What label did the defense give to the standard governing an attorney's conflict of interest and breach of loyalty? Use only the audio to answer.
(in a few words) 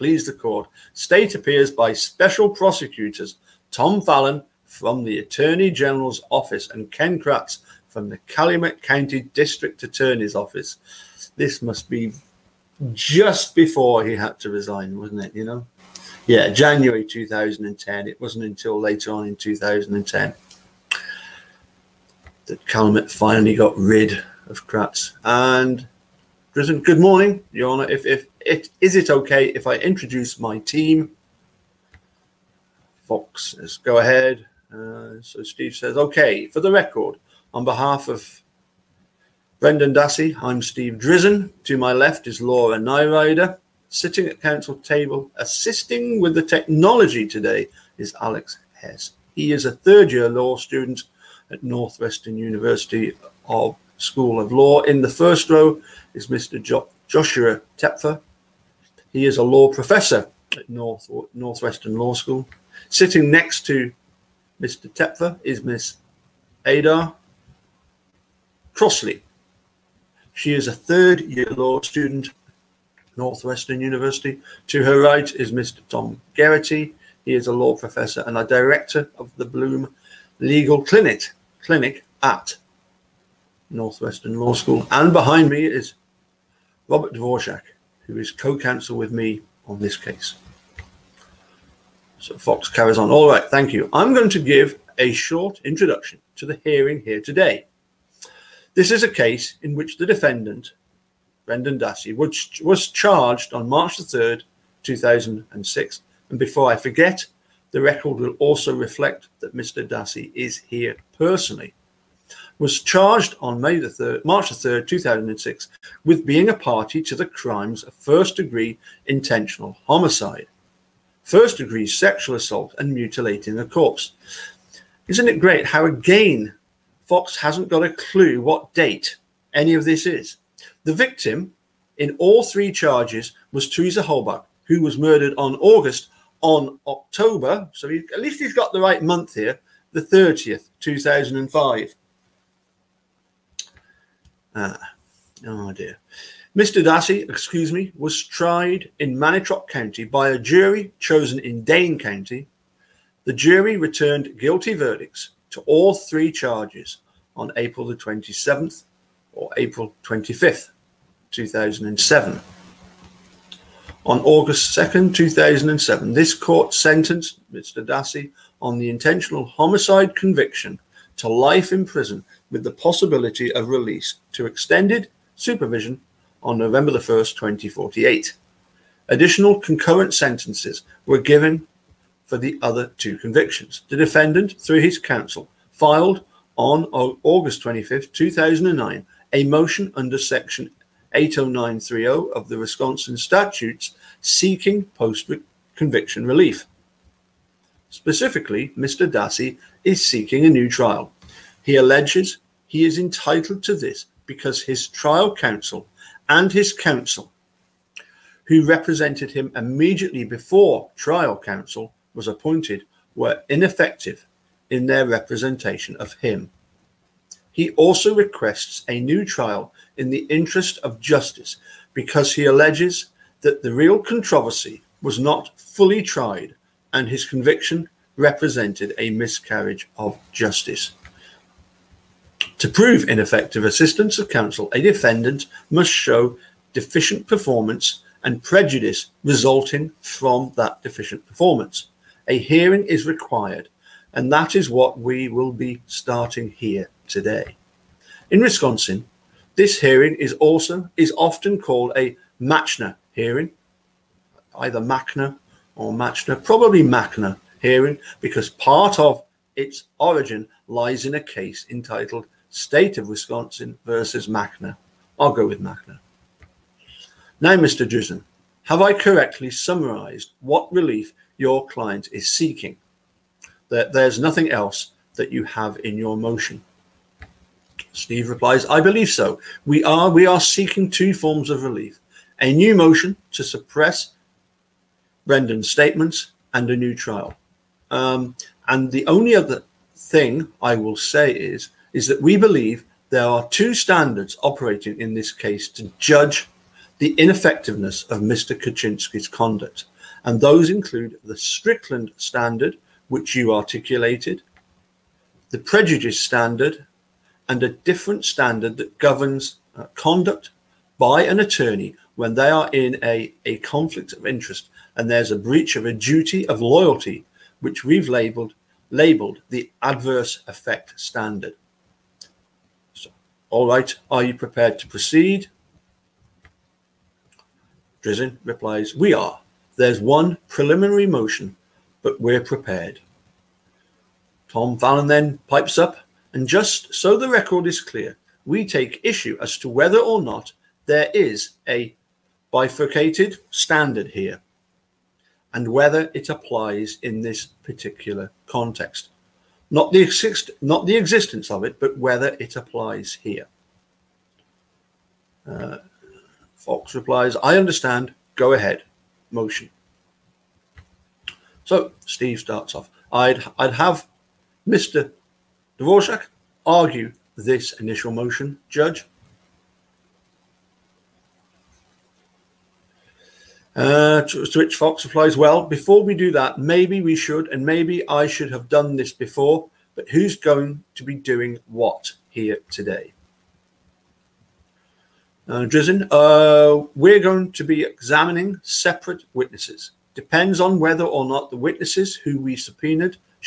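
adverse effect standard.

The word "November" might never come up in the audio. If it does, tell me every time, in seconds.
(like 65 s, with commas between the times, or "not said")
176 s.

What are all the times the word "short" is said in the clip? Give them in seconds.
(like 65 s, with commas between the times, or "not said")
95 s.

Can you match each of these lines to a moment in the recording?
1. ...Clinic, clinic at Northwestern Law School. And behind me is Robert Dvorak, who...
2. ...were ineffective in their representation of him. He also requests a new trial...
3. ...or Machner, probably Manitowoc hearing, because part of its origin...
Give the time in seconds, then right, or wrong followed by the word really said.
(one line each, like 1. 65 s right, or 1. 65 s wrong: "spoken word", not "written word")
1. 80 s right
2. 213 s right
3. 255 s wrong: "Machner", not "Manitowoc".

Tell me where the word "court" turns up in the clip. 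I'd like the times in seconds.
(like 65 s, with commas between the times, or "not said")
0 s, 166 s.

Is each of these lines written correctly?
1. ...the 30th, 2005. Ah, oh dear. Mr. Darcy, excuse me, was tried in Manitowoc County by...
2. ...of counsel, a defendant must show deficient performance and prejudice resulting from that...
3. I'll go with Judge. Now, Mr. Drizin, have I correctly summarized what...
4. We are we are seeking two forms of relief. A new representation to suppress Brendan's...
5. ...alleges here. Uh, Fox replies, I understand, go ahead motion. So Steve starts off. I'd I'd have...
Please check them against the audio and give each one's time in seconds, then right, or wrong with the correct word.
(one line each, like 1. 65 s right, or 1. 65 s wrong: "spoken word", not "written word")
1. 139 s right
2. 234 s right
3. 265 s wrong: "Machner", not "Judge"
4. 279 s wrong: "motion", not "representation"
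5. 352 s wrong: "applies", not "alleges".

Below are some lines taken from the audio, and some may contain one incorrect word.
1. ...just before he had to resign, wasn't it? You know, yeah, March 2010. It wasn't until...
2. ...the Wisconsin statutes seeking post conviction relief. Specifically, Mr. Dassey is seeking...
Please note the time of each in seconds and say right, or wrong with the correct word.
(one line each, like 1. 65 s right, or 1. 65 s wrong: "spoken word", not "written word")
1. 12 s wrong: "January", not "March"
2. 192 s right.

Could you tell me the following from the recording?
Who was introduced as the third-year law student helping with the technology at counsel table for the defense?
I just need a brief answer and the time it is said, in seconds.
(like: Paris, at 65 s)
Alex Hess, at 48 s.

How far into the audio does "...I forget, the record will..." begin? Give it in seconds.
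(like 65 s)
106 s.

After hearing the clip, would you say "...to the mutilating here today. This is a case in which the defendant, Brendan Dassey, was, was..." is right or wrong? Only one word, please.
wrong.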